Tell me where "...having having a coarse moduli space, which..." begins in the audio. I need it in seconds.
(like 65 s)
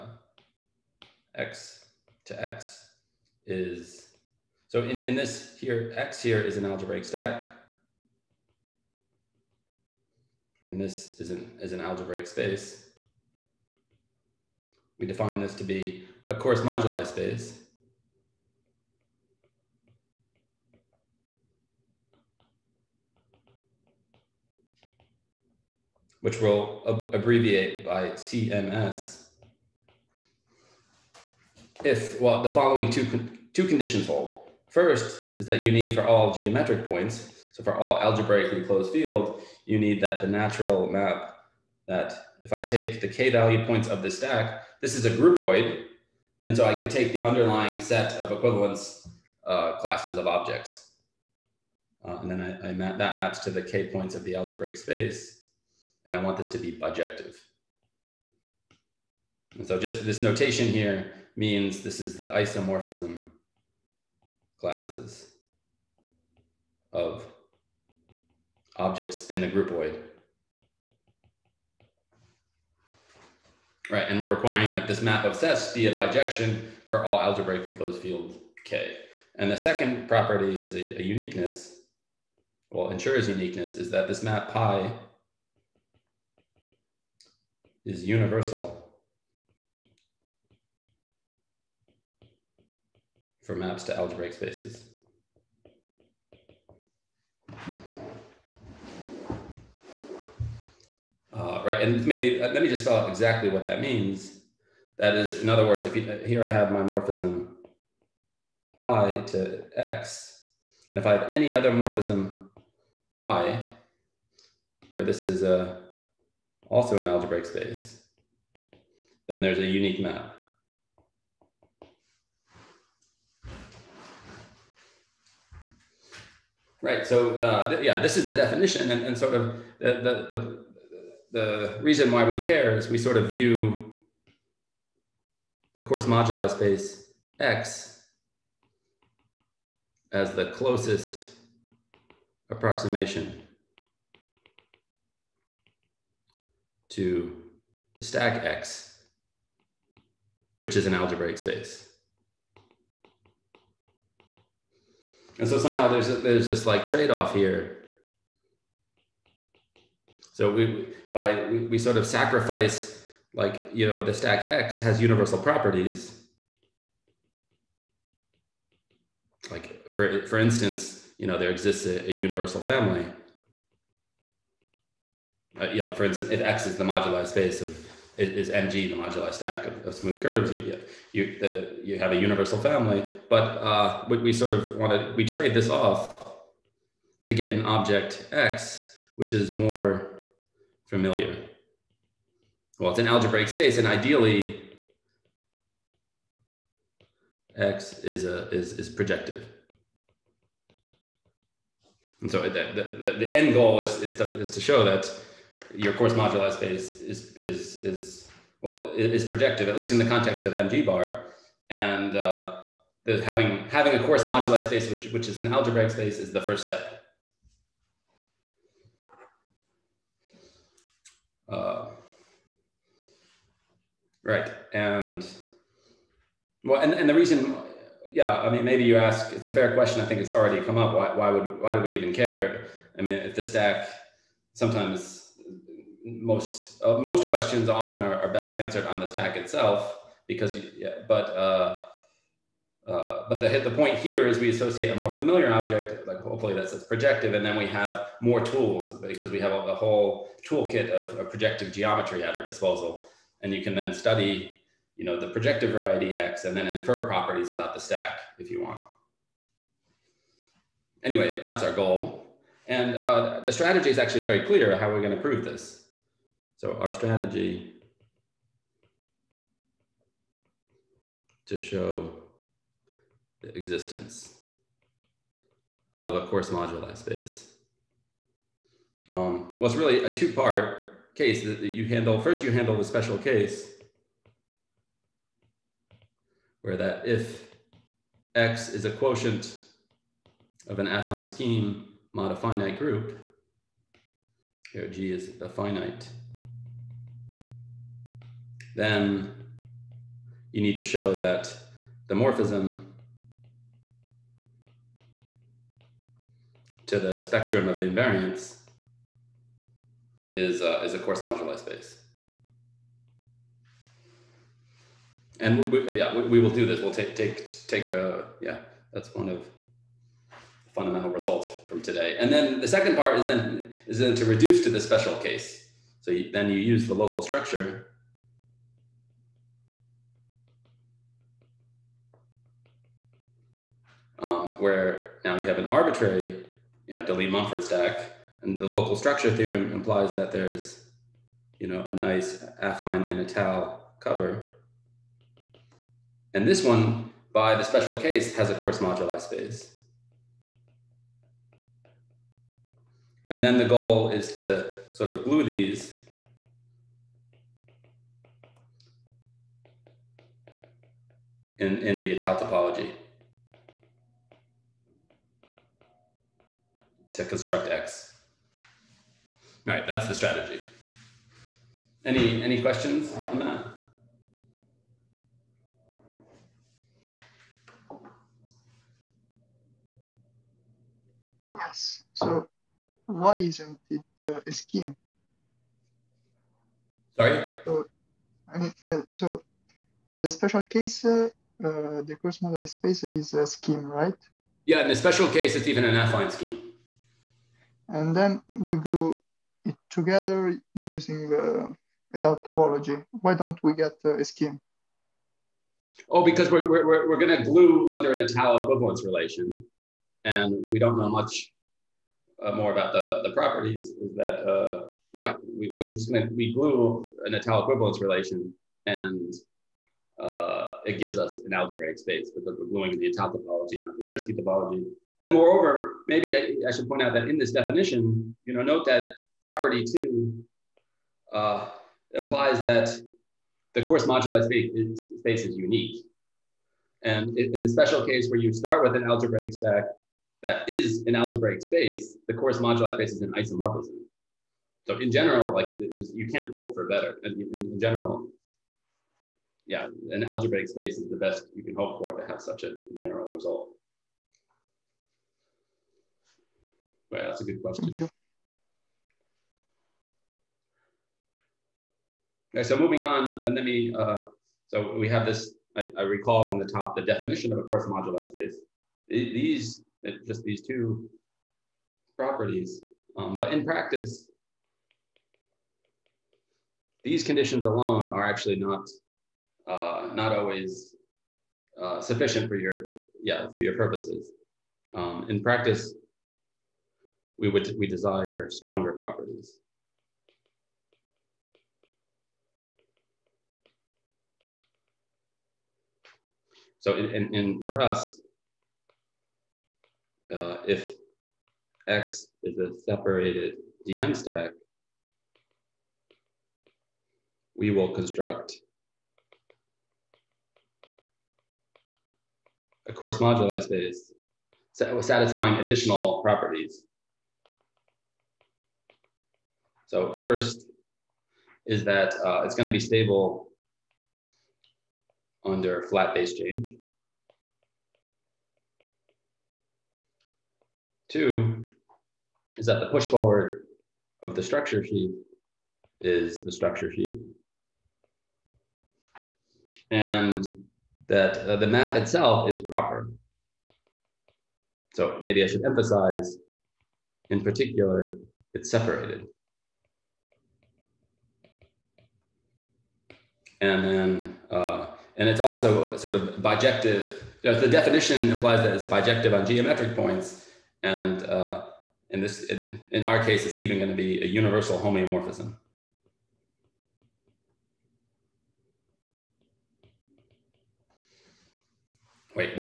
213 s.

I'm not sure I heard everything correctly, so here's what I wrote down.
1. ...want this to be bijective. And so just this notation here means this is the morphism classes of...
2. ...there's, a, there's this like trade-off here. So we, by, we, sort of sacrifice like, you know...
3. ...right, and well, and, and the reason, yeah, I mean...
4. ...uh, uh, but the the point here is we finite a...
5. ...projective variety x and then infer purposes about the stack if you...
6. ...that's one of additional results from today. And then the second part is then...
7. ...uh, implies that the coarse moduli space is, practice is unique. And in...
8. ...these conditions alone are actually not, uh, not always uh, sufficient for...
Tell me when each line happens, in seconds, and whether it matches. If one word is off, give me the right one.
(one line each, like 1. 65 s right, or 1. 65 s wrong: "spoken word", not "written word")
1. 56 s wrong: "isomorphism", not "morphism"
2. 155 s right
3. 224 s right
4. 241 s wrong: "associate", not "finite"
5. 255 s wrong: "properties", not "purposes"
6. 318 s wrong: "fundamental", not "additional"
7. 431 s wrong: "space", not "practice"
8. 477 s right.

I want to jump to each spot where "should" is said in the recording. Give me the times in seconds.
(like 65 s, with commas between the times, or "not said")
426 s, 545 s.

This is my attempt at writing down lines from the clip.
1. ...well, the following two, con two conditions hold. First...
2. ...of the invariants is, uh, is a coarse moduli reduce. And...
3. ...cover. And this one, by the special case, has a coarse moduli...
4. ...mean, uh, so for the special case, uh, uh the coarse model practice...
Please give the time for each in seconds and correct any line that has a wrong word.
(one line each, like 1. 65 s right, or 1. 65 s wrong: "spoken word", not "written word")
1. 32 s right
2. 307 s wrong: "space", not "reduce"
3. 343 s right
4. 388 s wrong: "space", not "practice".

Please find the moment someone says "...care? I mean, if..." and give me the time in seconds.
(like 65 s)
232 s.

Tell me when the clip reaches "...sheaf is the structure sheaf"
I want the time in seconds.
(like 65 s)
534 s.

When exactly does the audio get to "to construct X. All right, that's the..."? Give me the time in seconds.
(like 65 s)
367 s.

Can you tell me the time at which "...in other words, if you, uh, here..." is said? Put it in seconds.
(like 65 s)
105 s.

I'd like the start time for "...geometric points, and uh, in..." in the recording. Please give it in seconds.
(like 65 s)
559 s.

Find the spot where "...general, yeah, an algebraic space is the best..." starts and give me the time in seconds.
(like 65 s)
447 s.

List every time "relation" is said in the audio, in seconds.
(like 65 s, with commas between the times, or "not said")
409 s, 418 s.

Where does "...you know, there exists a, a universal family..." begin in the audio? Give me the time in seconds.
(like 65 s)
171 s.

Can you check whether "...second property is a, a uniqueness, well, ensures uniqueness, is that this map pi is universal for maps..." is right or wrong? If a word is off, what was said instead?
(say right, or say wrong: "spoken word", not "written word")
right.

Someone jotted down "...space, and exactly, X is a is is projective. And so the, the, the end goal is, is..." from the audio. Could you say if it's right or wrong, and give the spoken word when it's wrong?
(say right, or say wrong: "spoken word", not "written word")
wrong: "ideally", not "exactly".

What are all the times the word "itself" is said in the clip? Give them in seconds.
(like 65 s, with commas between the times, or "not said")
239 s, 541 s.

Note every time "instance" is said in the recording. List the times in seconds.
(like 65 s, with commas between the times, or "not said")
170 s, 176 s.